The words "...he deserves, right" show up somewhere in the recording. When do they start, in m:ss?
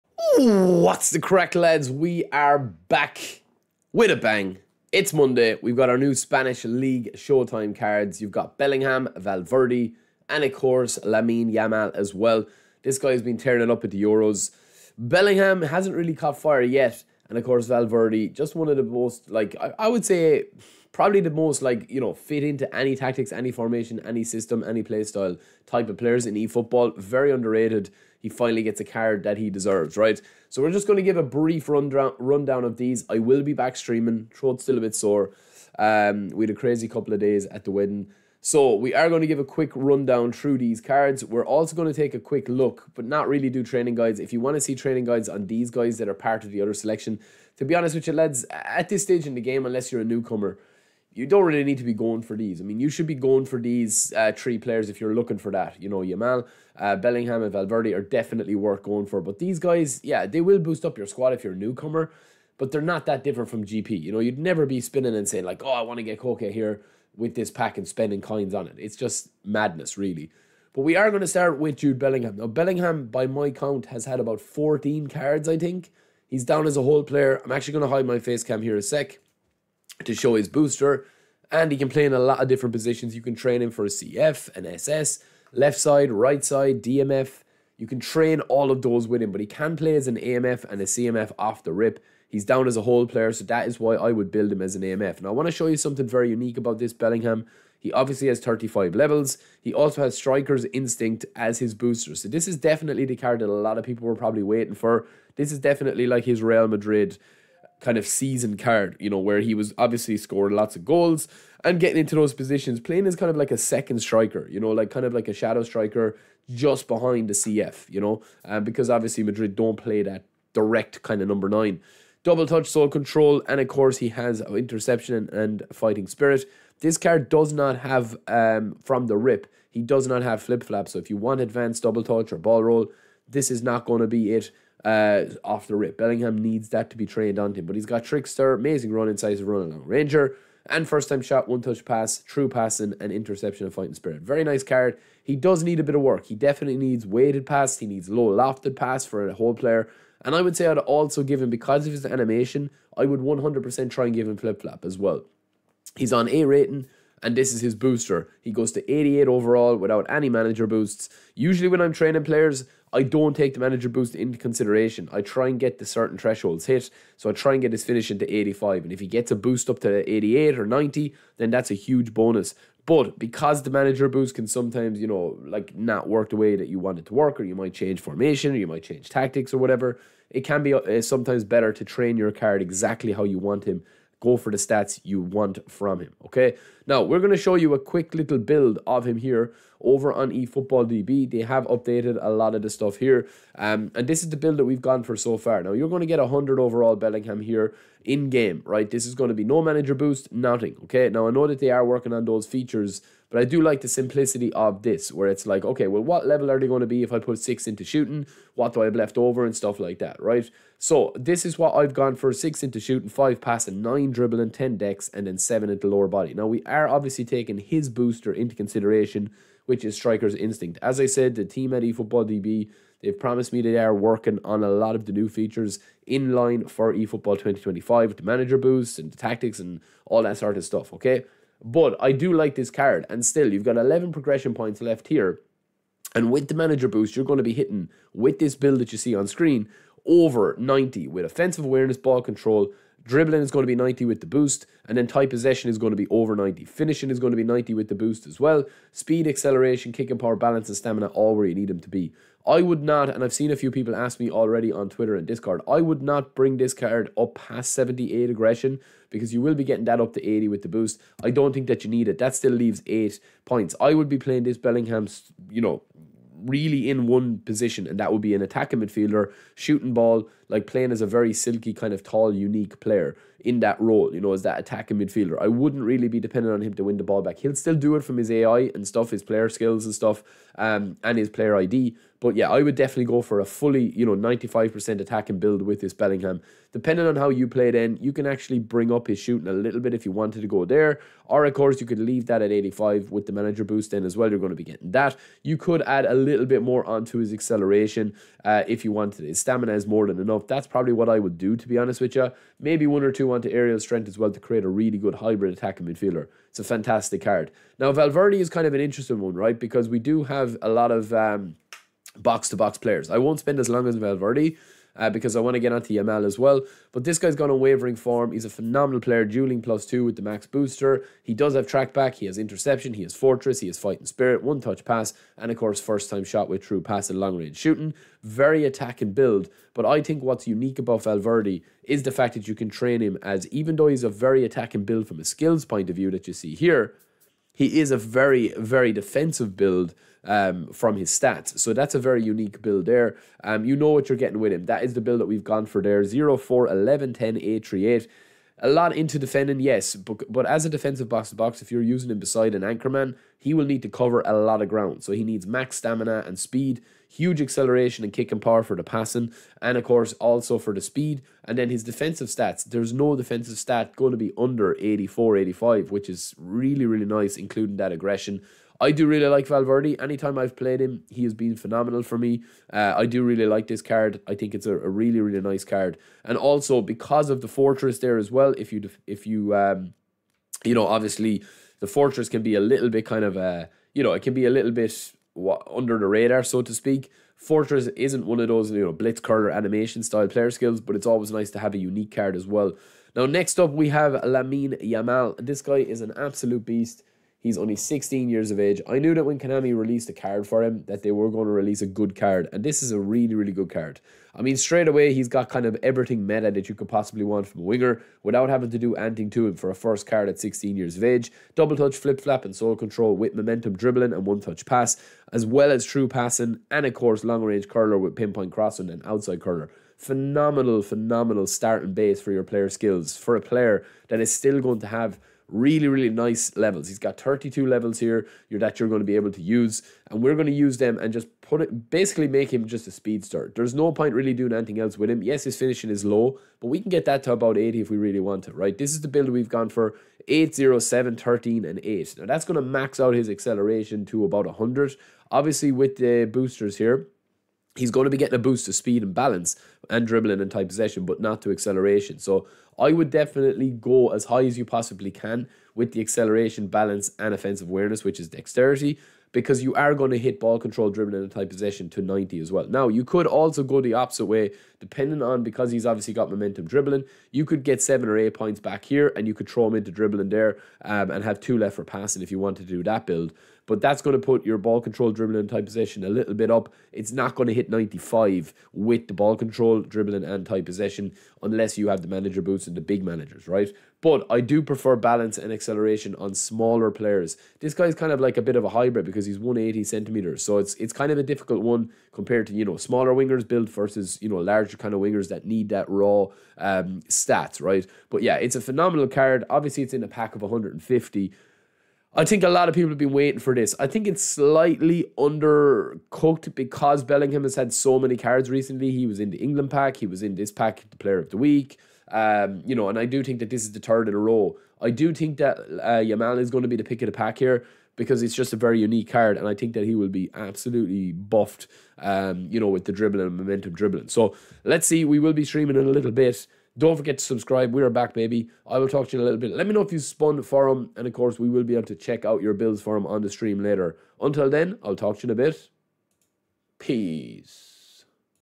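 0:29.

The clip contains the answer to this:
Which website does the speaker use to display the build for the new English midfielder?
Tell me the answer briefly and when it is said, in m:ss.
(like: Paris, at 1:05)
eFootballDB, at 3:10.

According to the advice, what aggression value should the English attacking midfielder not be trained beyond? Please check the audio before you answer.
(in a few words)
78.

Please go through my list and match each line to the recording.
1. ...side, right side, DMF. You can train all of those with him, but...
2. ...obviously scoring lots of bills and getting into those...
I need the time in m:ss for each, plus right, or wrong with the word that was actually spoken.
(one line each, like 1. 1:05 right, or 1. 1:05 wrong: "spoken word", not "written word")
1. 1:25 right
2. 1:49 wrong: "goals", not "bills".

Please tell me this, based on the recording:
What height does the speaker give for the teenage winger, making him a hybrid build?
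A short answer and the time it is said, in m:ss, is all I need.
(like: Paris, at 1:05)
180 centimeters, at 8:09.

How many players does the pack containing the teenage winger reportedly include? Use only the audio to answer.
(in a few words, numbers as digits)
150.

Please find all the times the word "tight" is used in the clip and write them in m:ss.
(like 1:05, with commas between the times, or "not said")
4:05, 7:30, 7:41, 7:55, 8:00.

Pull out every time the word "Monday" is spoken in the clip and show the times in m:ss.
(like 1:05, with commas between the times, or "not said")
0:05.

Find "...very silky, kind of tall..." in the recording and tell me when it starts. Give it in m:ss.
4:31.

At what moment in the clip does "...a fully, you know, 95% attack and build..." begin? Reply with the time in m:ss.
4:43.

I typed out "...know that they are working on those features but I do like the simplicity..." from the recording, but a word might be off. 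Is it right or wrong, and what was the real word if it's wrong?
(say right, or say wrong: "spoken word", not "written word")
right.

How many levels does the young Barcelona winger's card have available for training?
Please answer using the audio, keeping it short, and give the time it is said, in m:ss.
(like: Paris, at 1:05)
32, at 7:07.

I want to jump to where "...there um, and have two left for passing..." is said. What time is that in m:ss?
7:50.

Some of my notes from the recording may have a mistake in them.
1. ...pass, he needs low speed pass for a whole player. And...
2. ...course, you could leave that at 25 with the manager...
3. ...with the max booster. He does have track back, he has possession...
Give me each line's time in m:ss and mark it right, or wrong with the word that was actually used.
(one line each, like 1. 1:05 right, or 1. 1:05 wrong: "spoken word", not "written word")
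1. 2:27 wrong: "lofted", not "speed"
2. 4:51 wrong: "85", not "25"
3. 5:20 wrong: "interception", not "possession".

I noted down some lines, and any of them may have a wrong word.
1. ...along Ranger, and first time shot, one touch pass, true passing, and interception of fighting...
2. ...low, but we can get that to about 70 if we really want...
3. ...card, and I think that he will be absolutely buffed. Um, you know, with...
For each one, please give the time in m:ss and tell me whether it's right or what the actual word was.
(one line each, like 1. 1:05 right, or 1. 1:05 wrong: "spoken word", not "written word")
1. 2:19 right
2. 7:16 wrong: "80", not "70"
3. 8:39 right.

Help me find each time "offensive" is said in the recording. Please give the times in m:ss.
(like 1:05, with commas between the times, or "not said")
4:01, 7:37.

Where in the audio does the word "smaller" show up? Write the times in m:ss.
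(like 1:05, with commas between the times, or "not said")
8:06, 8:12.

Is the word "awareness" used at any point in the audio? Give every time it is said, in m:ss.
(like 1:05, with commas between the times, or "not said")
4:01, 7:37.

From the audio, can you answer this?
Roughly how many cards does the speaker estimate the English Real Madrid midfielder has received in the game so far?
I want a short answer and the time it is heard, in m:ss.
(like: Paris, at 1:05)
14, at 1:14.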